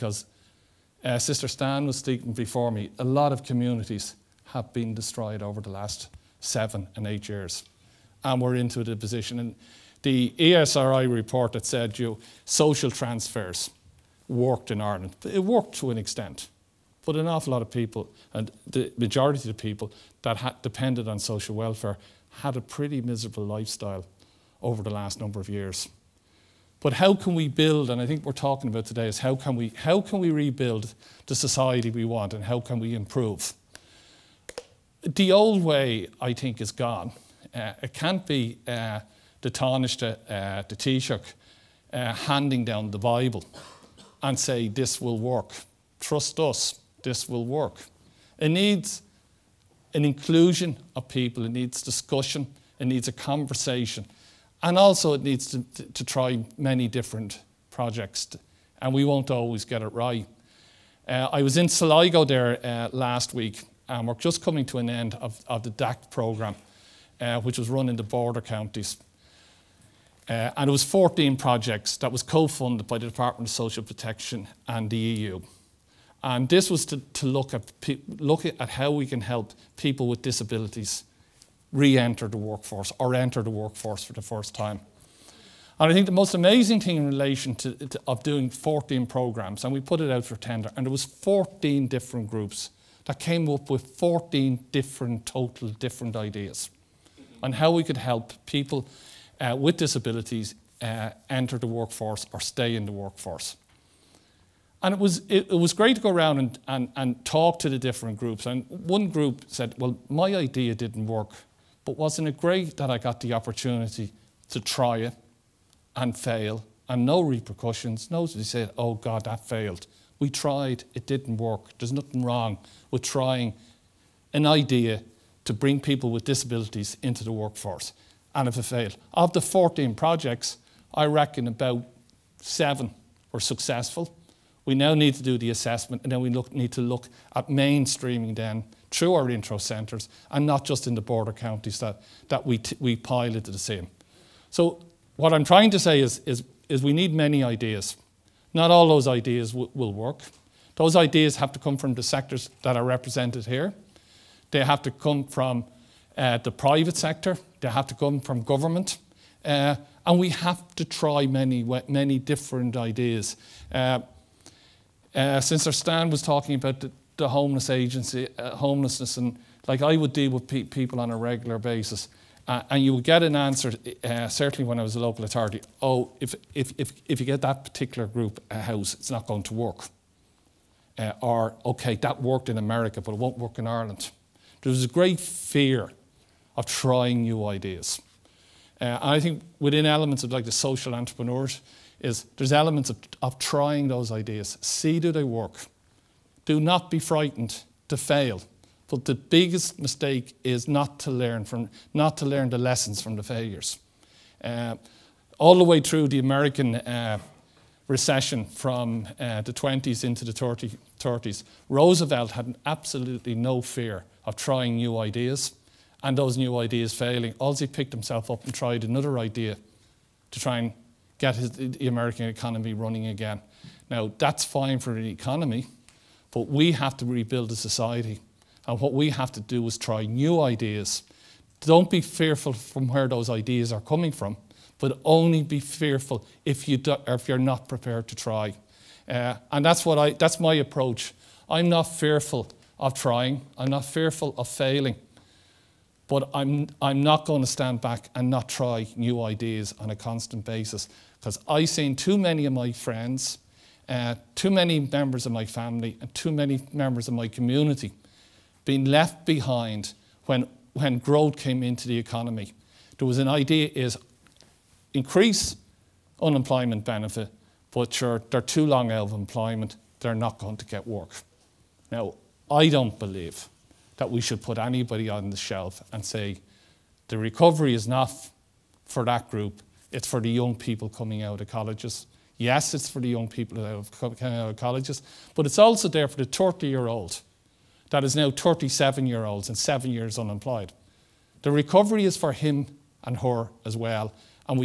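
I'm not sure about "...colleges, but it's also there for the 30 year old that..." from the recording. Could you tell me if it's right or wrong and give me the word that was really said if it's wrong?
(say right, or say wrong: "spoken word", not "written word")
right.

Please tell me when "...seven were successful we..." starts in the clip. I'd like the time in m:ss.
2:12.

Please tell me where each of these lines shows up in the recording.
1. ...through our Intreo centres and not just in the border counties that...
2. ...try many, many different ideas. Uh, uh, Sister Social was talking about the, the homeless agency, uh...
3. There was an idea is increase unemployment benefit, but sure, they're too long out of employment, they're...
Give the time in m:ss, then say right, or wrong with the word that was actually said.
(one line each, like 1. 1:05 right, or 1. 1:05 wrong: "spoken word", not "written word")
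1. 2:18 right
2. 2:40 wrong: "Stan", not "Social"
3. 4:22 right.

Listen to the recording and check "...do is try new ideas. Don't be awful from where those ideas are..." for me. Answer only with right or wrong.
wrong.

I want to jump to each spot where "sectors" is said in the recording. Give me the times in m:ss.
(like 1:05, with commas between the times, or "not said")
2:32, 2:36.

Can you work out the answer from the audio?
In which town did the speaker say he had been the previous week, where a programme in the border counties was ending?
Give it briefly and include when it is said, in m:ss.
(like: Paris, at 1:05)
Sligo, at 1:01.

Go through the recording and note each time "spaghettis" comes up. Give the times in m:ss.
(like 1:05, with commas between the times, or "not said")
not said.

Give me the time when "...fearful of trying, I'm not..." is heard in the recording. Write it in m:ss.
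4:01.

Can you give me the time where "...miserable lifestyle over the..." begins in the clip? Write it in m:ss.
0:23.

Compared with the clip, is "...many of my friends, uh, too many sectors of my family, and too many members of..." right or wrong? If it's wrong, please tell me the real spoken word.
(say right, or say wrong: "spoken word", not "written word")
wrong: "members", not "sectors".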